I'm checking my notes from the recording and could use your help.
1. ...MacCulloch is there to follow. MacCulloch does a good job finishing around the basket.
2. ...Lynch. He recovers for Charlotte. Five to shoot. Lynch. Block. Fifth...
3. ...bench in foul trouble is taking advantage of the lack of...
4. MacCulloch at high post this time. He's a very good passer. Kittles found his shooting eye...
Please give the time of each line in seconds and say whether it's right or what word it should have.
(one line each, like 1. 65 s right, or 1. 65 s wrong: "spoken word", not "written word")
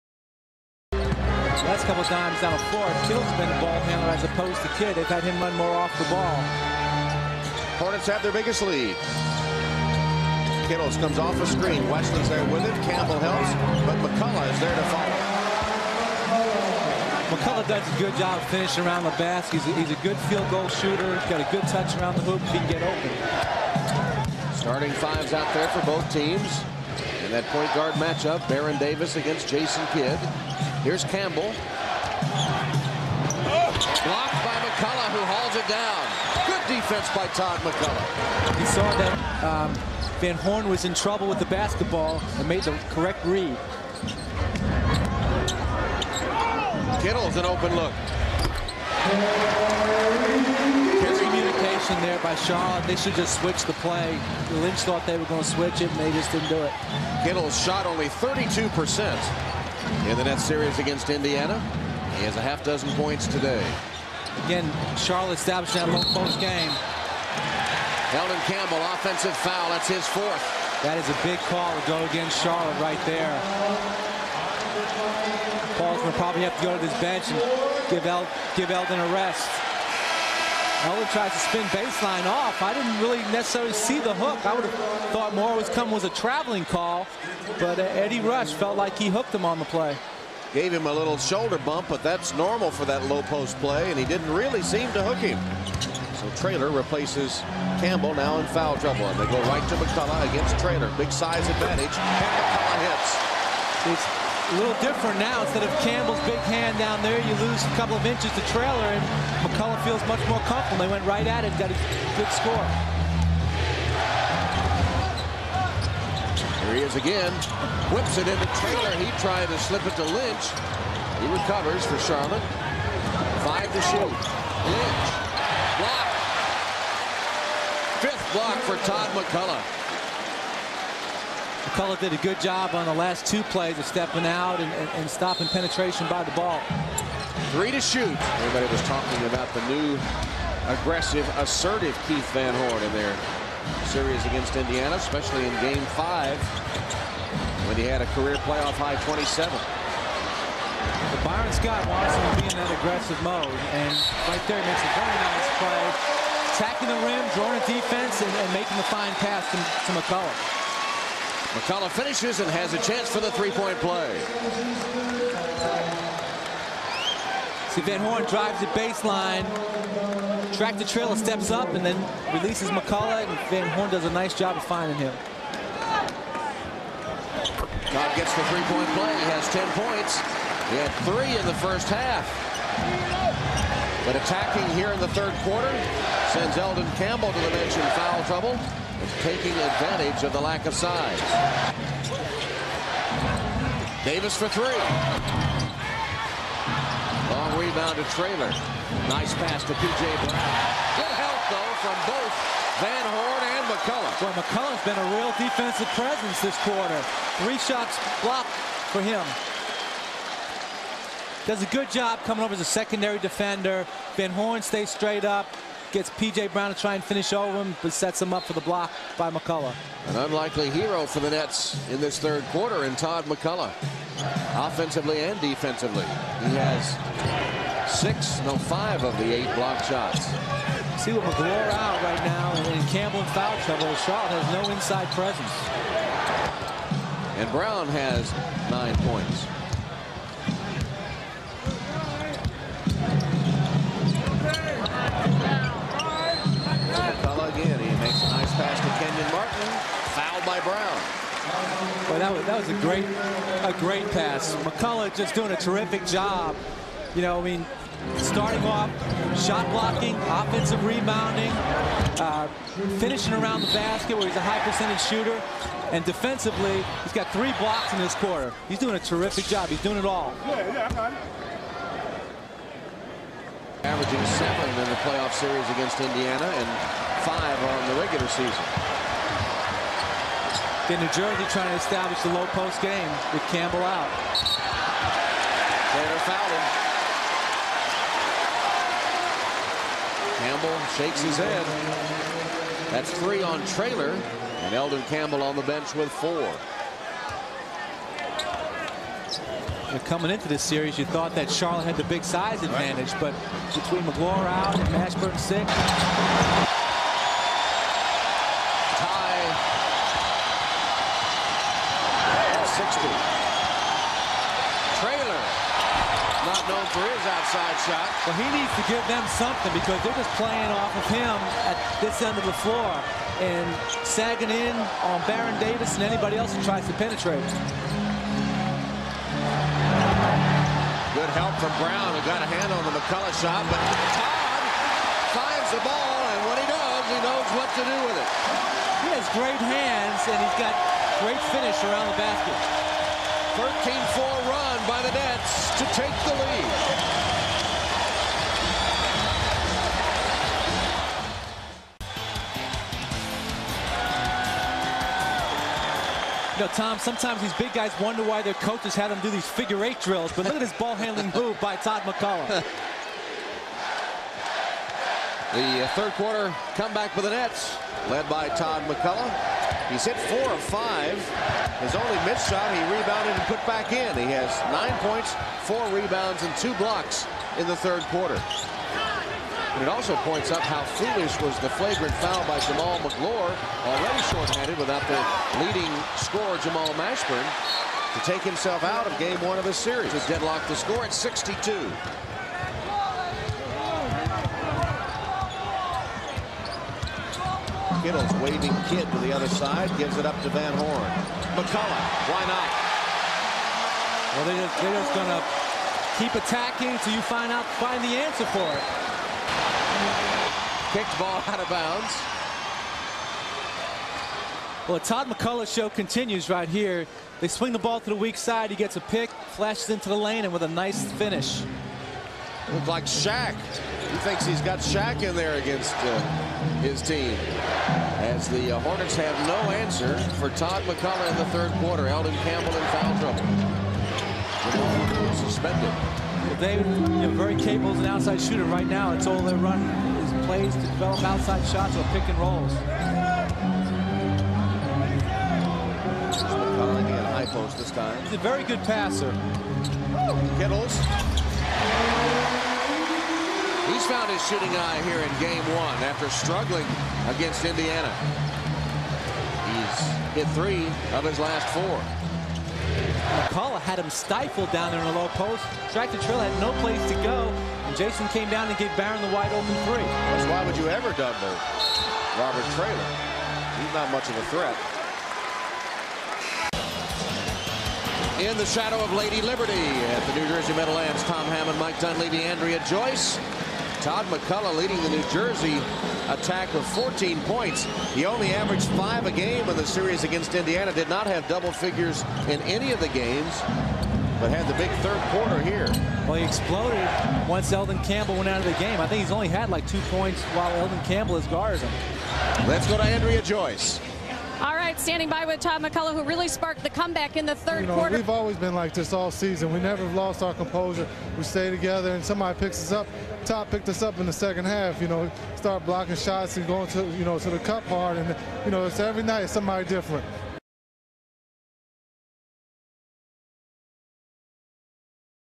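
1. 14 s right
2. 120 s right
3. 187 s right
4. 446 s right.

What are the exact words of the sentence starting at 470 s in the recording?
That's why would you ever double Robert Traylor?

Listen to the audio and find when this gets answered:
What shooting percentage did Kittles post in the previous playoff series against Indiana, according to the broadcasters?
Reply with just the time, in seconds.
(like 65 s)
58 s.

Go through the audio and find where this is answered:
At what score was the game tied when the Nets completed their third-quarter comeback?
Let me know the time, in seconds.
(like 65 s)
391 s.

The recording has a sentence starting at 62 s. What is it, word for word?
He has a half dozen points today.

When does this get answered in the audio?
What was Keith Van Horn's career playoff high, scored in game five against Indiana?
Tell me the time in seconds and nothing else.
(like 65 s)
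149 s.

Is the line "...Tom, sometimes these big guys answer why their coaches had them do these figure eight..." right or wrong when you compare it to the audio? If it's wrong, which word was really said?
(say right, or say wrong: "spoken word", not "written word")
wrong: "wonder", not "answer".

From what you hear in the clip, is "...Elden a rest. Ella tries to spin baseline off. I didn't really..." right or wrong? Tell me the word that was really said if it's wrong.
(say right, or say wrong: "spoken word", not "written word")
right.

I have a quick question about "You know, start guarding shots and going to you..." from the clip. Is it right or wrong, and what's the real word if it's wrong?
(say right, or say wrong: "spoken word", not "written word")
wrong: "blocking", not "guarding".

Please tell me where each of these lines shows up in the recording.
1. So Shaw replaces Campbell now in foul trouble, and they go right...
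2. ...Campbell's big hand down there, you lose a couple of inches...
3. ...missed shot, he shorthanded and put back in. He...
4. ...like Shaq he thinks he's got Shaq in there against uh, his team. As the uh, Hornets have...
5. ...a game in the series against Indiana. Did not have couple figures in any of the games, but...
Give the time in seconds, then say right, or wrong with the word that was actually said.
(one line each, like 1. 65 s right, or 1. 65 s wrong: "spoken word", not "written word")
1. 96 s wrong: "Traylor", not "Shaw"
2. 105 s right
3. 372 s wrong: "rebounded", not "shorthanded"
4. 422 s right
5. 489 s wrong: "double", not "couple".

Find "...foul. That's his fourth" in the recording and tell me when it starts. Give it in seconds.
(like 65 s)
69 s.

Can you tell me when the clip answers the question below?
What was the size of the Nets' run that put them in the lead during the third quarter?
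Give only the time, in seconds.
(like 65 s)
343 s.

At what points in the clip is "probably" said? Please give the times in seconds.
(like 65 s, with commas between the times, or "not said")
76 s.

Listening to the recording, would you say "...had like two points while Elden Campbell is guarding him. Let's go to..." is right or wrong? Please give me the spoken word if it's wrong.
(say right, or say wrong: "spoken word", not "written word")
right.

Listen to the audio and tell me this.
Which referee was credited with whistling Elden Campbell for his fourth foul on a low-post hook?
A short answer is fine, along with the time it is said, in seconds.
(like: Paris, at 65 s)
Eddie Rush, at 87 s.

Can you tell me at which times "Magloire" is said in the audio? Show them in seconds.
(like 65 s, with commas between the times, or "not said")
231 s, 304 s, 383 s.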